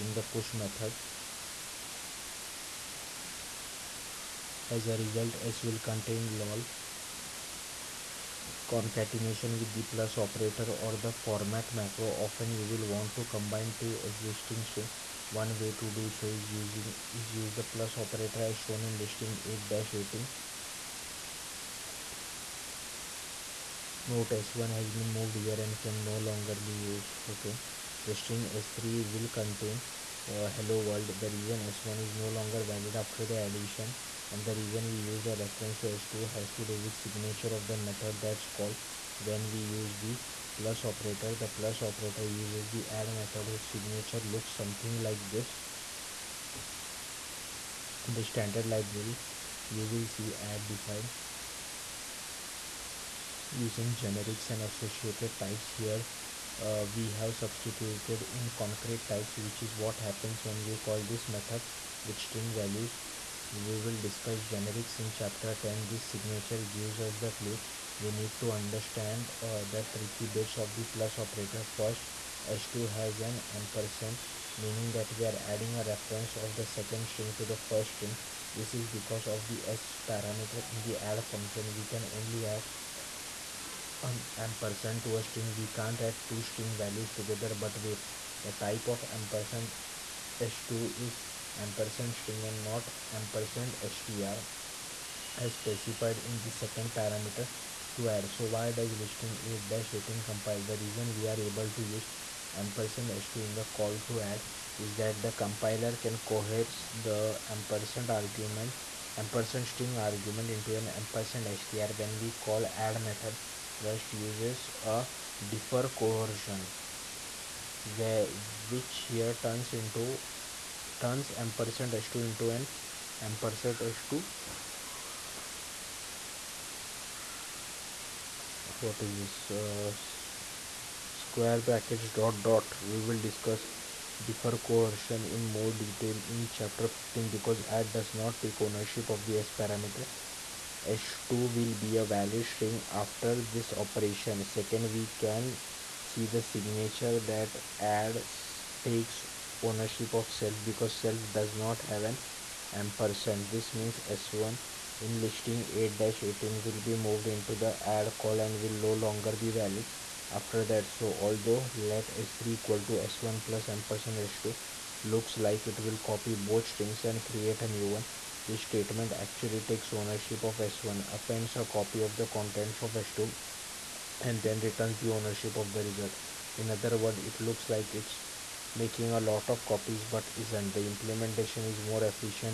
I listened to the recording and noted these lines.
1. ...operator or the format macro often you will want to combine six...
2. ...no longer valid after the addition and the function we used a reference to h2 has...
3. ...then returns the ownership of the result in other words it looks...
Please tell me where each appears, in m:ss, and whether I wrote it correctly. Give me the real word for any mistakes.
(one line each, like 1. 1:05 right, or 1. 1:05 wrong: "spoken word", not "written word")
1. 0:10 wrong: "two", not "six"
2. 0:32 wrong: "reason", not "function"
3. 2:54 right.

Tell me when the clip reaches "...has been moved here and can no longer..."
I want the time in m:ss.
0:24.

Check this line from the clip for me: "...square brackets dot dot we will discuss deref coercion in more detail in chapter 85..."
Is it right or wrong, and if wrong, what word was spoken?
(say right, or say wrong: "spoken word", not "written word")
wrong: "15", not "85".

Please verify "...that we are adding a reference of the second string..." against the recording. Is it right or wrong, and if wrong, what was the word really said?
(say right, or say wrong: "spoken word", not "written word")
right.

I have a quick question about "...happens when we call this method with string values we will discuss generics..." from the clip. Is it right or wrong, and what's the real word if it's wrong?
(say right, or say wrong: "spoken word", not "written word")
right.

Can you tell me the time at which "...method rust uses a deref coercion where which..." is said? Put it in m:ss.
1:53.